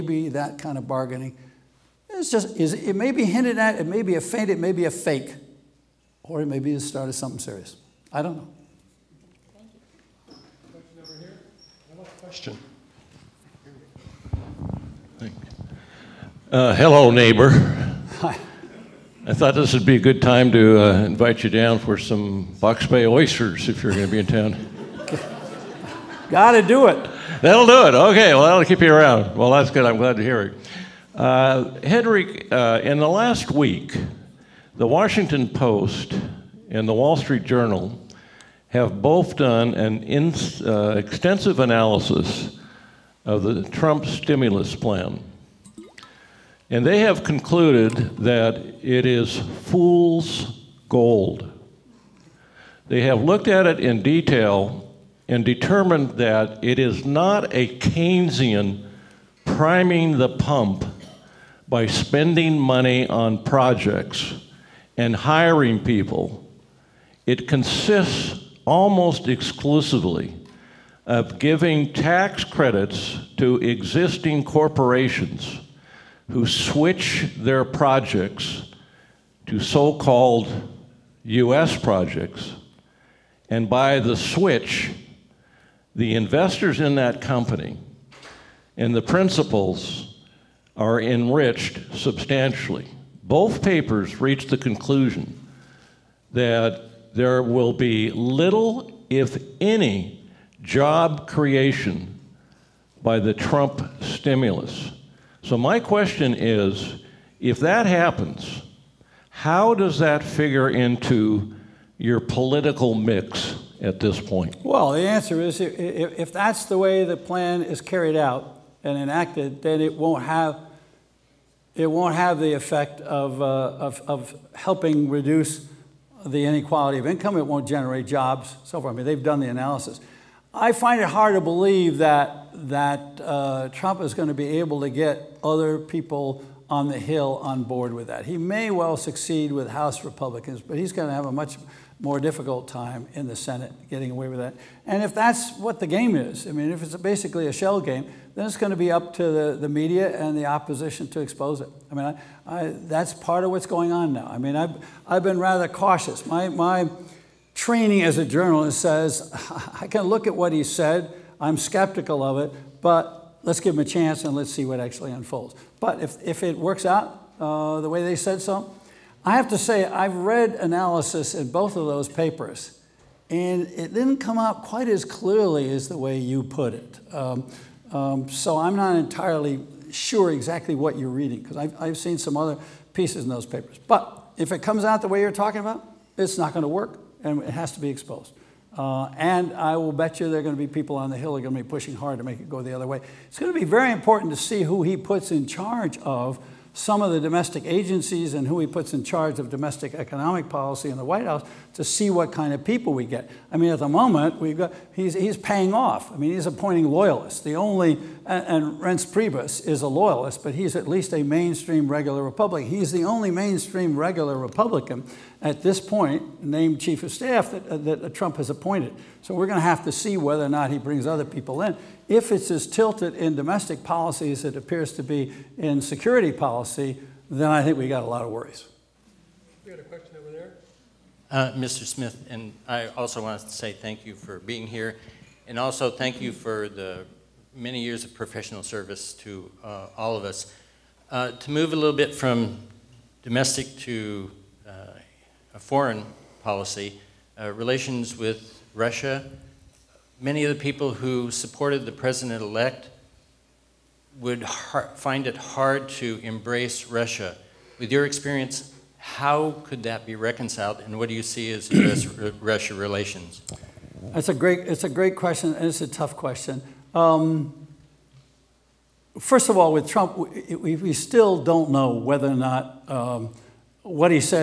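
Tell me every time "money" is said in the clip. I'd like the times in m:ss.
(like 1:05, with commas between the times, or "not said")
1:02.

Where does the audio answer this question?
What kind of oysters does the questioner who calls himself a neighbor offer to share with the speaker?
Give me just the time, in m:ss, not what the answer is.
0:22.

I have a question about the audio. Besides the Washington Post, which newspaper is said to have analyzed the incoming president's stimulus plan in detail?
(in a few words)
Wall Street Journal.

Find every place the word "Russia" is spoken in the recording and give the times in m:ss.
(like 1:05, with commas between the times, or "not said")
4:08, 4:16, 4:21.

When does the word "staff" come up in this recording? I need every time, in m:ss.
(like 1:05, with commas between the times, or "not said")
3:37.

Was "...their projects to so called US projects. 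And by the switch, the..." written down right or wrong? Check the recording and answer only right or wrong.
right.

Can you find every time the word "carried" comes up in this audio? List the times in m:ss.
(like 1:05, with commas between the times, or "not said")
1:57.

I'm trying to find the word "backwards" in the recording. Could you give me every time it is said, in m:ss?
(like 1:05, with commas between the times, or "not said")
not said.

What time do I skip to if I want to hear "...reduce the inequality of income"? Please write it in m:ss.
2:05.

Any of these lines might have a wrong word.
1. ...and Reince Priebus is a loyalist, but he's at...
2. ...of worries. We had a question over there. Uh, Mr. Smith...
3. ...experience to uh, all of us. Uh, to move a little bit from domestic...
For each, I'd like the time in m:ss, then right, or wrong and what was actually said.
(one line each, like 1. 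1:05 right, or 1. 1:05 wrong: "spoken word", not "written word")
1. 3:28 right
2. 3:48 right
3. 3:58 wrong: "service", not "experience".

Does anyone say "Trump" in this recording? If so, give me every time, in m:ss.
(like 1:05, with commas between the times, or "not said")
0:43, 1:43, 2:13, 3:38, 4:29.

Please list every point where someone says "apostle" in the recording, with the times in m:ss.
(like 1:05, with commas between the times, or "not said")
not said.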